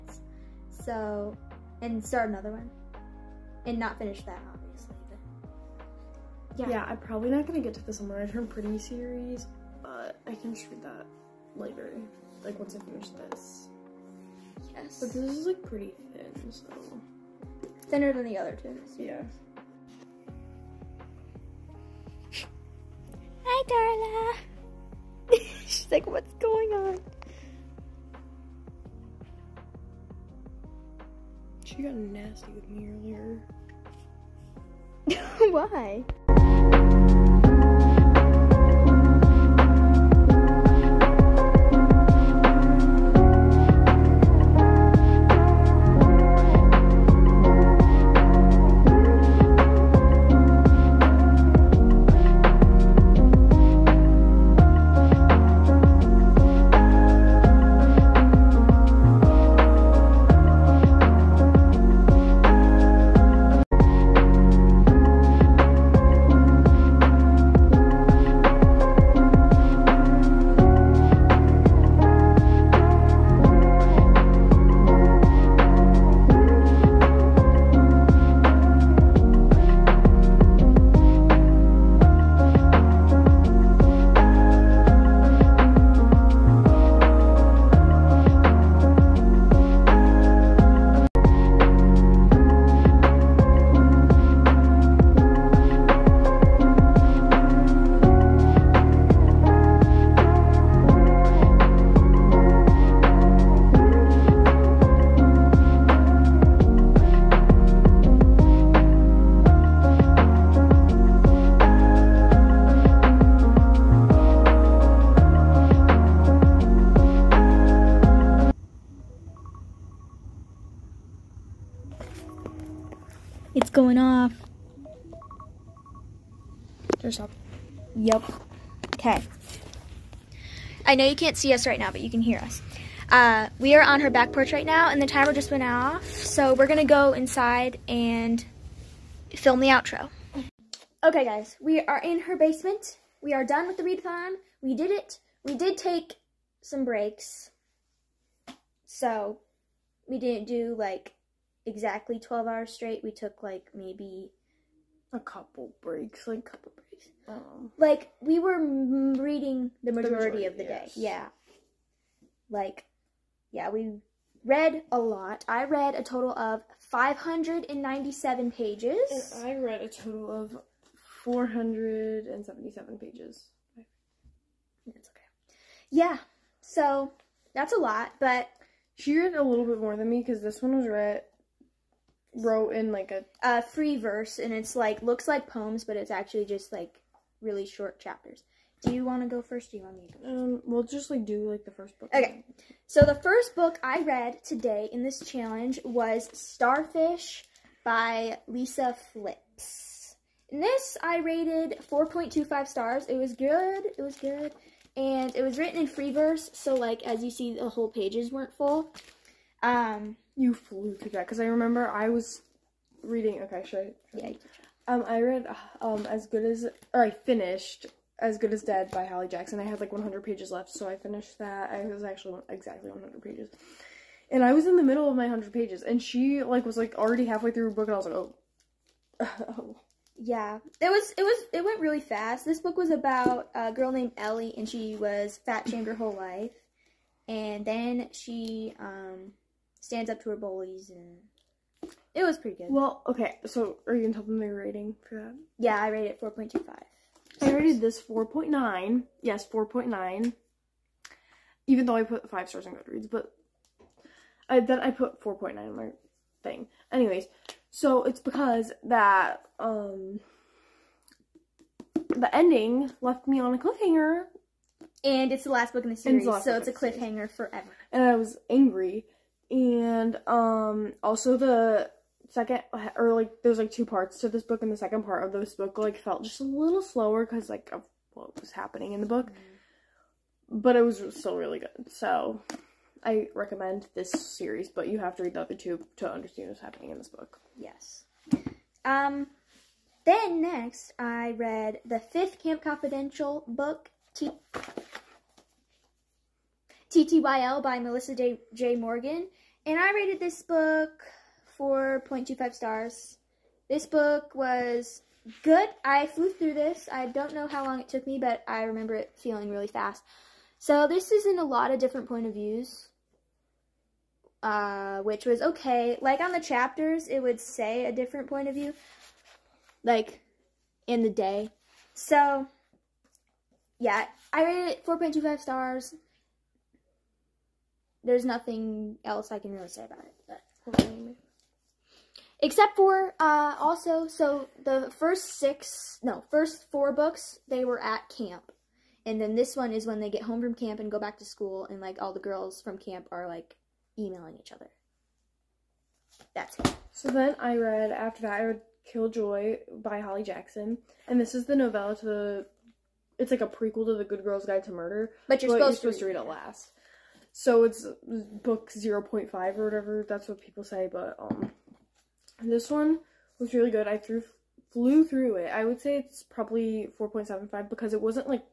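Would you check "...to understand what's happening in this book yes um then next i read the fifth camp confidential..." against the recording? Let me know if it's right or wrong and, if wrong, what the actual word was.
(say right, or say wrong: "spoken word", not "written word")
right.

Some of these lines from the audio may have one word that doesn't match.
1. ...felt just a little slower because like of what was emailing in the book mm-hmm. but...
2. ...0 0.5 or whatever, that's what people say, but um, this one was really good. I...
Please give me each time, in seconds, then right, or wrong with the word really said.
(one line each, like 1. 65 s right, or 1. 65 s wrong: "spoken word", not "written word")
1. 275 s wrong: "happening", not "emailing"
2. 358 s right.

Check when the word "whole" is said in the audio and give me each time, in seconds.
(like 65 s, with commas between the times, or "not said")
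207 s, 235 s.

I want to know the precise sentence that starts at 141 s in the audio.
Okay, guys, we are in her basement.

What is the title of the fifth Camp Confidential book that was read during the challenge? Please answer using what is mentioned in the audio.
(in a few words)
TTYL.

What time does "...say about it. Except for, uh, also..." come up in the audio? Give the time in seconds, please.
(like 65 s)
329 s.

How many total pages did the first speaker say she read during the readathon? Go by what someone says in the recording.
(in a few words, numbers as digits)
597.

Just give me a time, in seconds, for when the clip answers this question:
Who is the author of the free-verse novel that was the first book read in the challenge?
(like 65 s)
198 s.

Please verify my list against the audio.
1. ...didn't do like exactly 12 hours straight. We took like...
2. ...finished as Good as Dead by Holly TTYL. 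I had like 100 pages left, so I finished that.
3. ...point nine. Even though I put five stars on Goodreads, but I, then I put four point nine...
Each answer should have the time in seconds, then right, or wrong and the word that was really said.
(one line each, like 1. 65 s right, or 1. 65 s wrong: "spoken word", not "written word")
1. 150 s right
2. 217 s wrong: "Jackson", not "TTYL"
3. 249 s right.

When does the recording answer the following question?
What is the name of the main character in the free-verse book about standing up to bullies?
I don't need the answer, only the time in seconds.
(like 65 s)
234 s.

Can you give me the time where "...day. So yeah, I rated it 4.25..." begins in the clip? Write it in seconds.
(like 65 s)
321 s.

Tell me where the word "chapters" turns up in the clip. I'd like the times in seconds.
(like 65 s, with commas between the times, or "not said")
187 s, 316 s.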